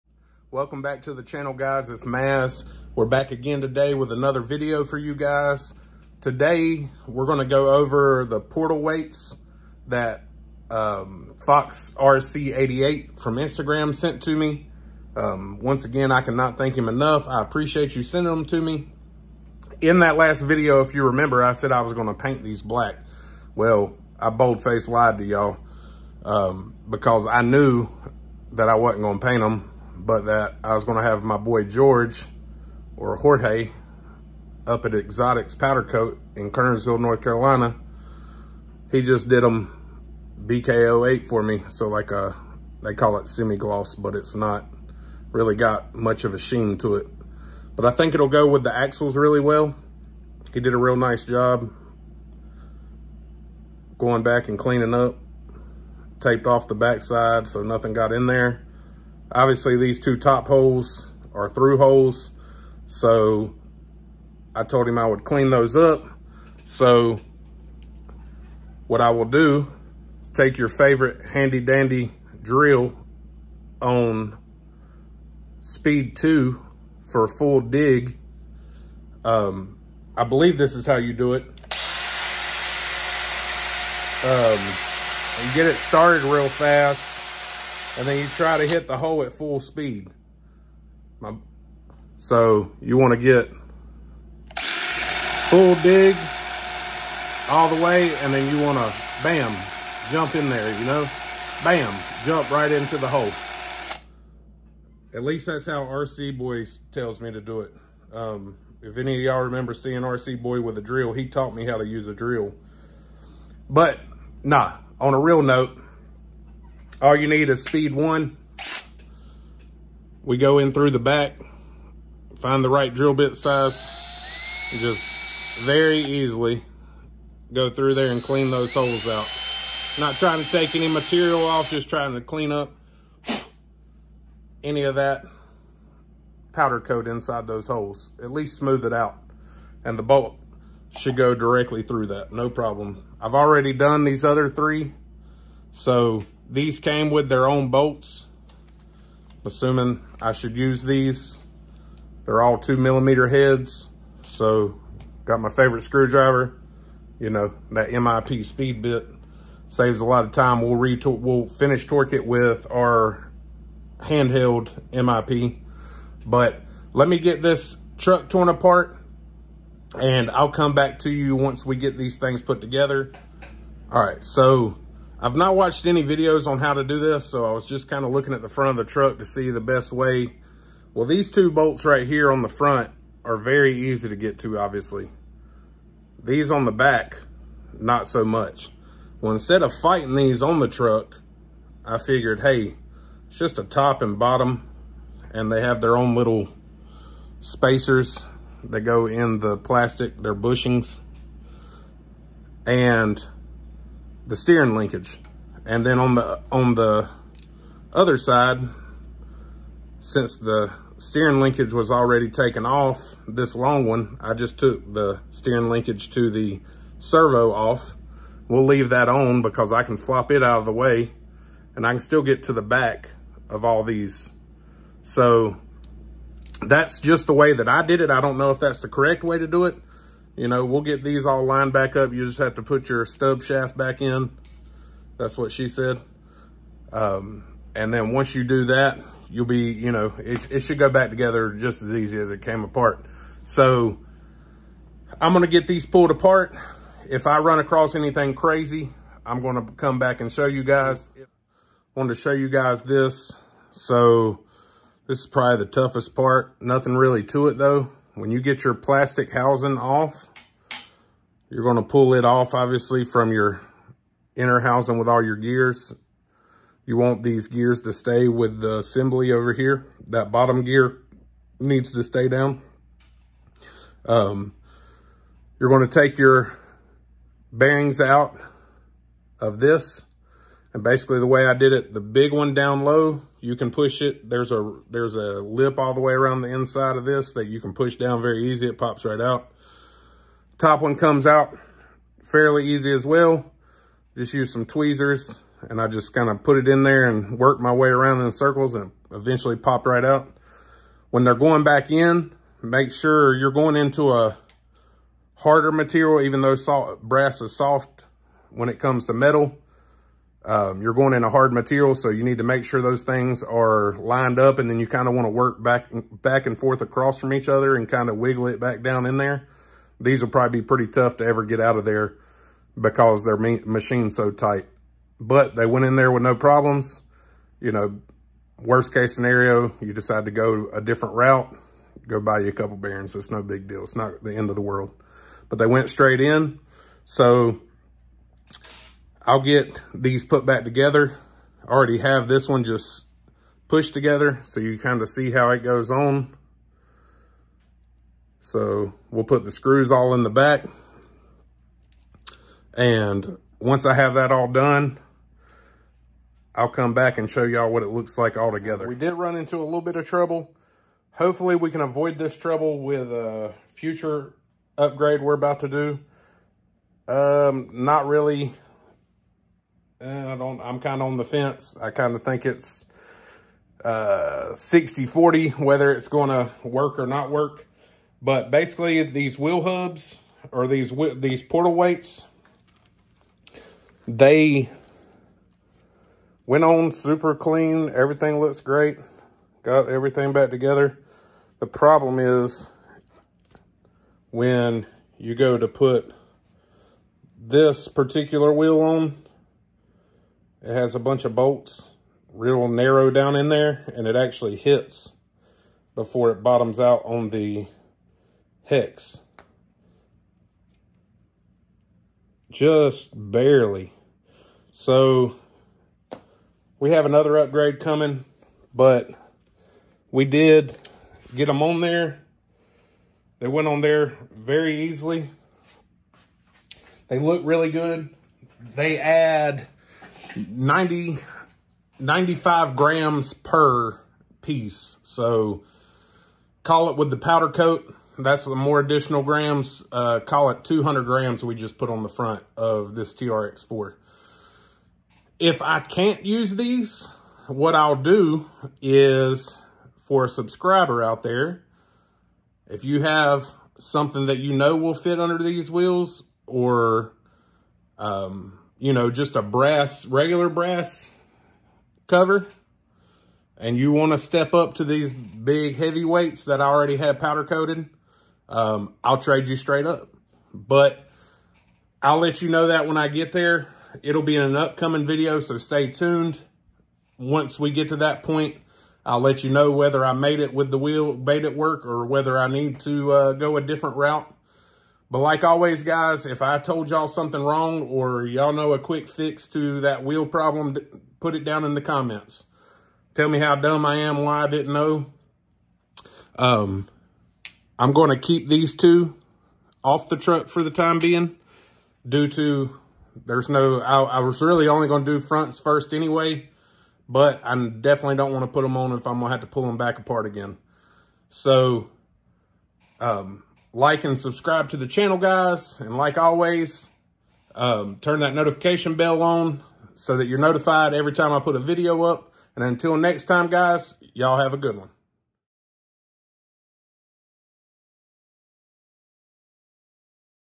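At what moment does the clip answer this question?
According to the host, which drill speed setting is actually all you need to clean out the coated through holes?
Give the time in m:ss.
1:57.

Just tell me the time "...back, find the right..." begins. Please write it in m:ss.
2:00.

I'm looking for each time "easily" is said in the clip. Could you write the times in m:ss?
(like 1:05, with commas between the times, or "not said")
2:05, 7:04.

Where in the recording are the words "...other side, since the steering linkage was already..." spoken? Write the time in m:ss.
3:27.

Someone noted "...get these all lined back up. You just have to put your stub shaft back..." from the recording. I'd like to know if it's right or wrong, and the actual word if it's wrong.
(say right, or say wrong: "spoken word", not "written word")
right.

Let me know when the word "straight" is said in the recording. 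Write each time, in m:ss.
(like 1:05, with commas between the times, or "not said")
5:35, 7:49.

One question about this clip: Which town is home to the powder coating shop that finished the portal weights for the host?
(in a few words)
Kernersville, North Carolina.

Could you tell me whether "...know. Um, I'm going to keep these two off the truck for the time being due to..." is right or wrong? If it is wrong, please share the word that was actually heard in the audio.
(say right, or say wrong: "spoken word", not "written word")
right.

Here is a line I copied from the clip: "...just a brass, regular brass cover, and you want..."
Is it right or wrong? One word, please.
right.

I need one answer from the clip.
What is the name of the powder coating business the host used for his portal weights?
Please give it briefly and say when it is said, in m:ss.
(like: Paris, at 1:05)
Exotics Powder Coat, at 0:34.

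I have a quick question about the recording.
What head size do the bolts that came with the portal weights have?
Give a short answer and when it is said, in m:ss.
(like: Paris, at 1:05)
2 millimeter, at 2:32.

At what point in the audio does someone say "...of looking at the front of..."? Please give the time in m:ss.
2:58.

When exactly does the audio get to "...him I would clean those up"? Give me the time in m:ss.
1:04.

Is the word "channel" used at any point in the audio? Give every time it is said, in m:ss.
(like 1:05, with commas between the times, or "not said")
0:01, 8:34.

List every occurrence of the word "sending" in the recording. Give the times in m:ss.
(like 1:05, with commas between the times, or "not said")
0:18.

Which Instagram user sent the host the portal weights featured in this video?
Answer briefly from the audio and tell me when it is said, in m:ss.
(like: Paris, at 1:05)
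Fox RC88, at 0:11.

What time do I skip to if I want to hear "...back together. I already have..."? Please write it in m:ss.
5:40.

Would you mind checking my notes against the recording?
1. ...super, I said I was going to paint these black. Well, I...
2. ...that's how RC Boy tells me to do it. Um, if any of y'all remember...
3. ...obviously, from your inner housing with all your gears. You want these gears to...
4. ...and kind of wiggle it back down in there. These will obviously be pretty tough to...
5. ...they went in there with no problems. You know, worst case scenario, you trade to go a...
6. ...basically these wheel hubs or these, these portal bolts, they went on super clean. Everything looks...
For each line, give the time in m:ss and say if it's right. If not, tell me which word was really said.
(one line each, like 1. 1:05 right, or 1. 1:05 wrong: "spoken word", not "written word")
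1. 0:21 wrong: "remember", not "super"
2. 1:45 right
3. 4:22 right
4. 5:17 wrong: "probably", not "obviously"
5. 5:25 wrong: "decide", not "trade"
6. 6:18 wrong: "weights", not "bolts".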